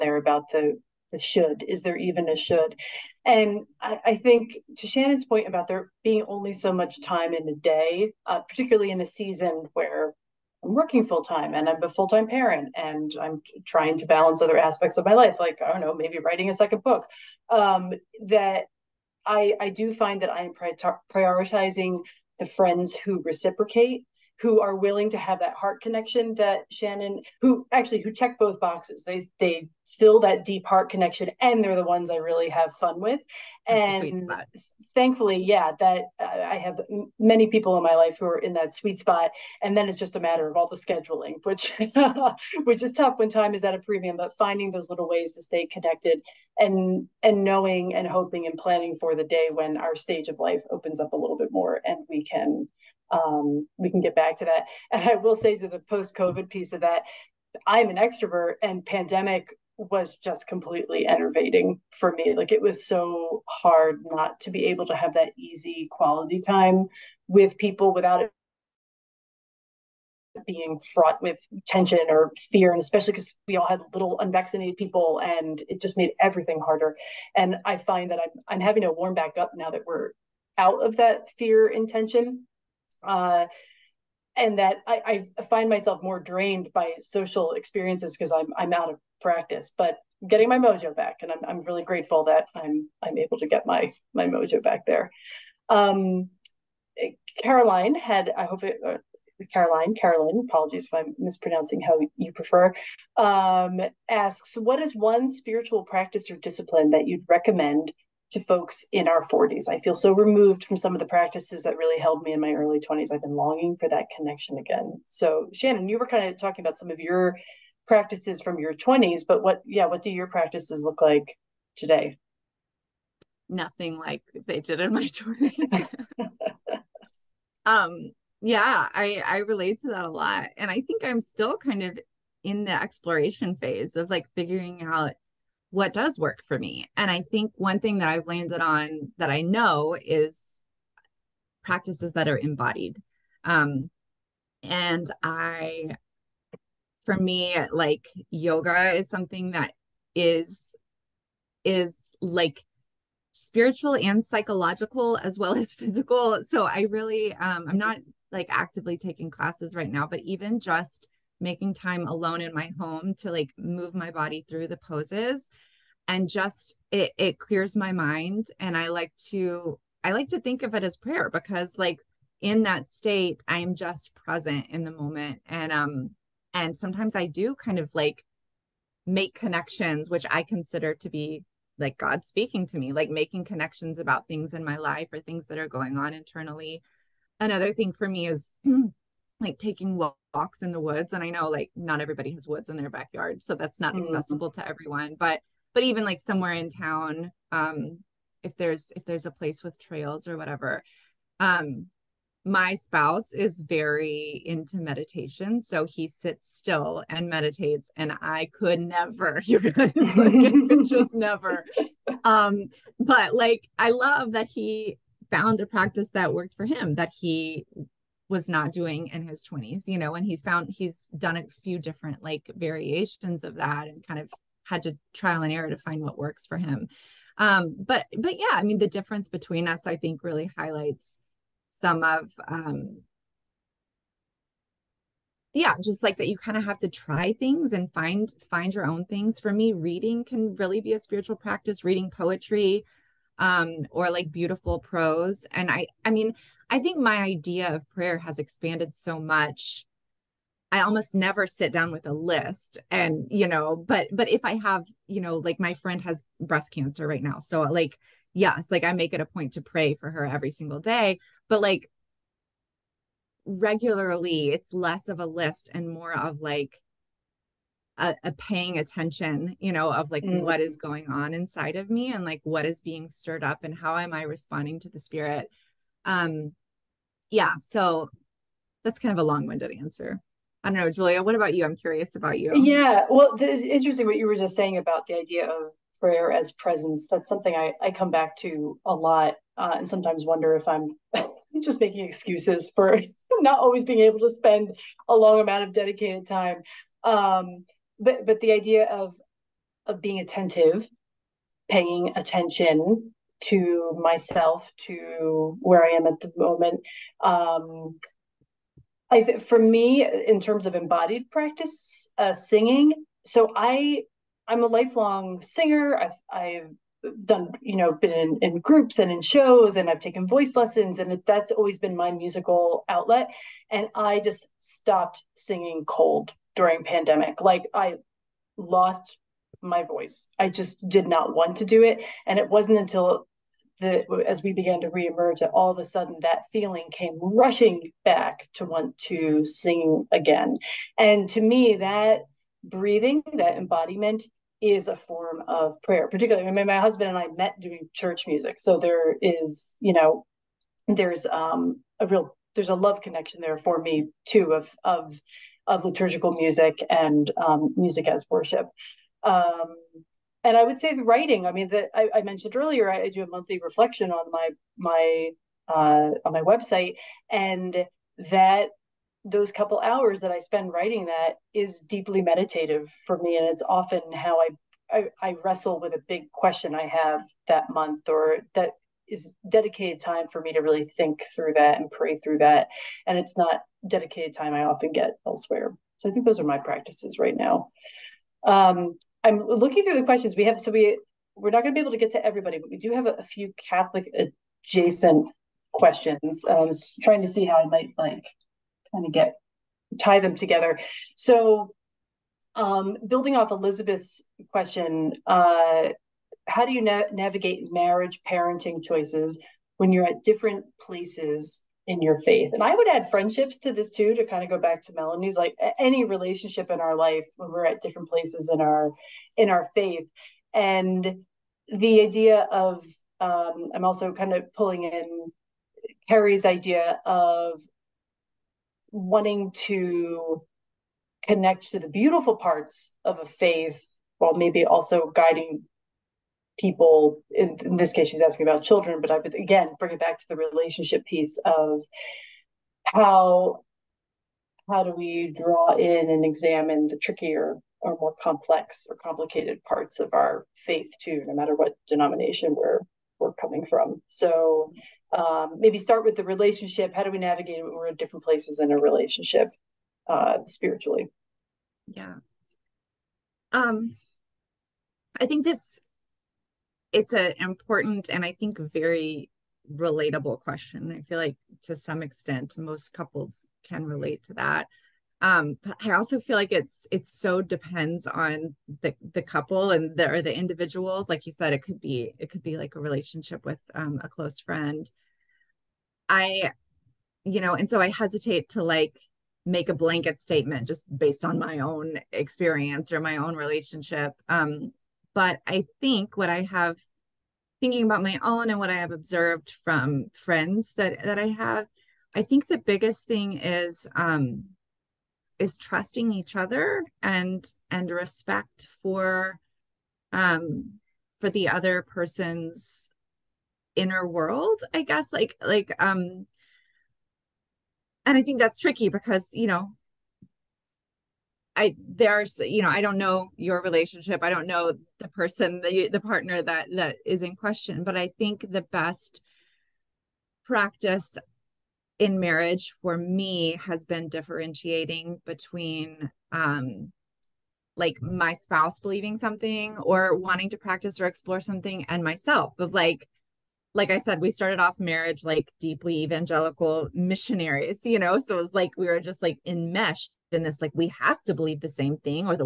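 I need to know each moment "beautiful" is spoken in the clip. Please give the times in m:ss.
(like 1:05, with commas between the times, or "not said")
4:04, 7:11.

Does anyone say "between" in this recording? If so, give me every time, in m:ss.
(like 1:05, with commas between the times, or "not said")
3:49, 8:55.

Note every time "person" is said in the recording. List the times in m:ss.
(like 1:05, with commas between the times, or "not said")
8:31, 8:45.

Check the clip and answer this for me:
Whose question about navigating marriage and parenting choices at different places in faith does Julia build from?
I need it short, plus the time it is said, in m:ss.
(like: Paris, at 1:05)
Elizabeth, at 6:43.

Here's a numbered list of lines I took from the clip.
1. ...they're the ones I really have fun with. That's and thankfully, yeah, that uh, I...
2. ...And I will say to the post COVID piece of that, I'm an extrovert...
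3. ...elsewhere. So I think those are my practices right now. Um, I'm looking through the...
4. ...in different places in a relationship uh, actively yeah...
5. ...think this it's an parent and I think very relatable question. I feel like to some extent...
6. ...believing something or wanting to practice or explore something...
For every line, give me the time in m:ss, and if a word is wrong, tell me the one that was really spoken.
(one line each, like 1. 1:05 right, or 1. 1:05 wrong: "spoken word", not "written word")
1. 0:31 right
2. 0:54 right
3. 6:25 right
4. 7:37 wrong: "spiritually", not "actively"
5. 7:45 wrong: "important", not "parent"
6. 8:58 right.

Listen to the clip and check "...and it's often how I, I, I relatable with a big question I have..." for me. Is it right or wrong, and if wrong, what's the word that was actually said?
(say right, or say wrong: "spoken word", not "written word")
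wrong: "wrestle", not "relatable".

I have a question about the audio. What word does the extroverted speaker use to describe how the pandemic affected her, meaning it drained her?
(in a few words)
enervating.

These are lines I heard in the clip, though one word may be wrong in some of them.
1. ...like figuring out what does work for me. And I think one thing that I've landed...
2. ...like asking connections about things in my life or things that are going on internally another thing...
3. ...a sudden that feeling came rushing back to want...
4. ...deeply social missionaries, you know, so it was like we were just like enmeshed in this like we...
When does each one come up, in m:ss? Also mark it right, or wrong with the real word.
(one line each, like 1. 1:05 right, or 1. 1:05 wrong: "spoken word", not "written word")
1. 2:14 right
2. 3:02 wrong: "making", not "asking"
3. 5:35 right
4. 9:05 wrong: "evangelical", not "social".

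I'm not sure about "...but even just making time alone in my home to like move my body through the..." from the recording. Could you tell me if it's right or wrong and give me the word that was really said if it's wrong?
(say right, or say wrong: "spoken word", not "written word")
right.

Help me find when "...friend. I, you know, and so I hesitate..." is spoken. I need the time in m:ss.
8:04.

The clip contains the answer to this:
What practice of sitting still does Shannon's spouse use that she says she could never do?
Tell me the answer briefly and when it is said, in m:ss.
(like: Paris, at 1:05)
meditation, at 3:24.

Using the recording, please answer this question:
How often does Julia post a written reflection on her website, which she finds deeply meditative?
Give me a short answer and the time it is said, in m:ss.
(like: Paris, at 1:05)
monthly, at 6:03.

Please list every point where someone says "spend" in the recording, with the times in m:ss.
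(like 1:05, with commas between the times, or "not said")
4:54, 6:10.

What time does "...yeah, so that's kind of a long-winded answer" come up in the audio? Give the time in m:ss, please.
4:37.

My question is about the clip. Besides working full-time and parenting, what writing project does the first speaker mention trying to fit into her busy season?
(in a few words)
a second book.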